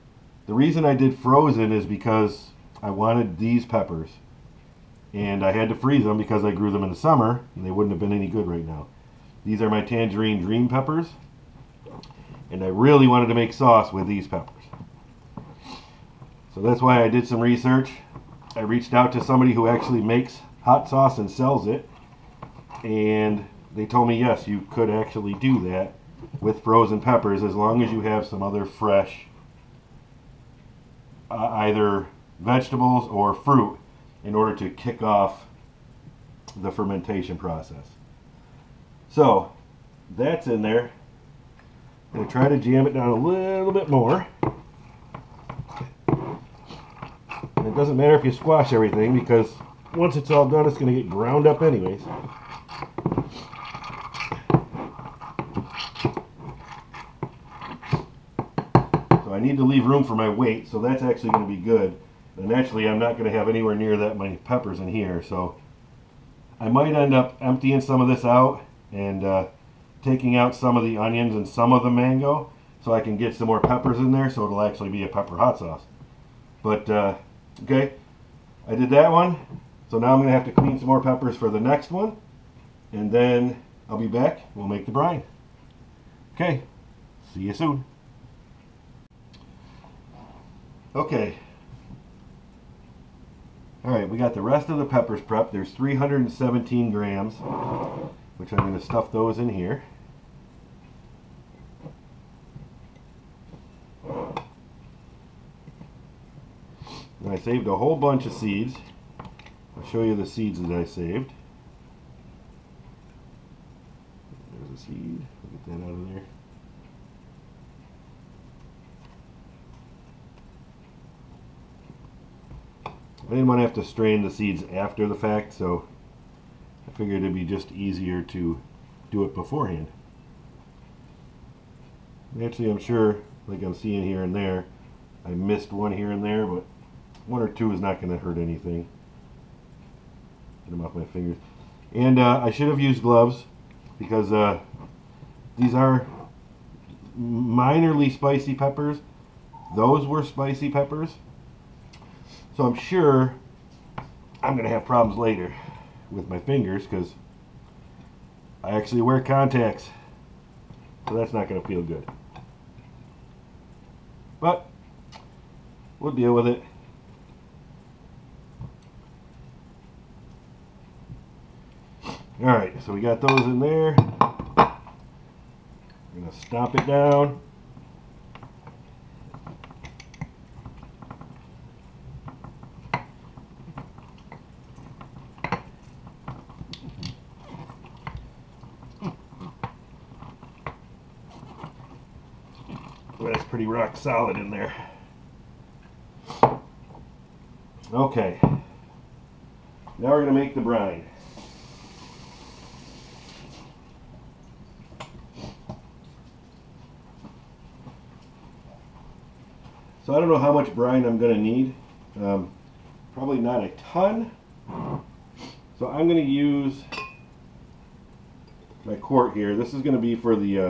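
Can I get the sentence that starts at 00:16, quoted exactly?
So that's why I did some research.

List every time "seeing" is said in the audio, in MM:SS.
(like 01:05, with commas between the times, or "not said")
02:13.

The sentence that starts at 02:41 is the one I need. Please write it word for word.
So that's not going to feel good.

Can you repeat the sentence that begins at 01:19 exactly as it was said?
So now I'm going to have to clean some more peppers for the next one.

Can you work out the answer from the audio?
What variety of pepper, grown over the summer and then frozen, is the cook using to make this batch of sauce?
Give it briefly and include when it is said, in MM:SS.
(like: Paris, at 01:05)
Tangerine Dream, at 00:09.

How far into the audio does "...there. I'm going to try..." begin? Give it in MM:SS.
00:40.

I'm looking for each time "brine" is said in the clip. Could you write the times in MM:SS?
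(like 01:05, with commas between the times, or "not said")
01:24, 03:20, 03:30.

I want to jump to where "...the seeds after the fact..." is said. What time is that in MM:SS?
02:04.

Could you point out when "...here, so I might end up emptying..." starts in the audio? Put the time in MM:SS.
01:04.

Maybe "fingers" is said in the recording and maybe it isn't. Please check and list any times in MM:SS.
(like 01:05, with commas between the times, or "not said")
02:21, 02:36.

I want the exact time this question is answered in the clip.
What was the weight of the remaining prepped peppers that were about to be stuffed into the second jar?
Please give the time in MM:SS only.
01:35.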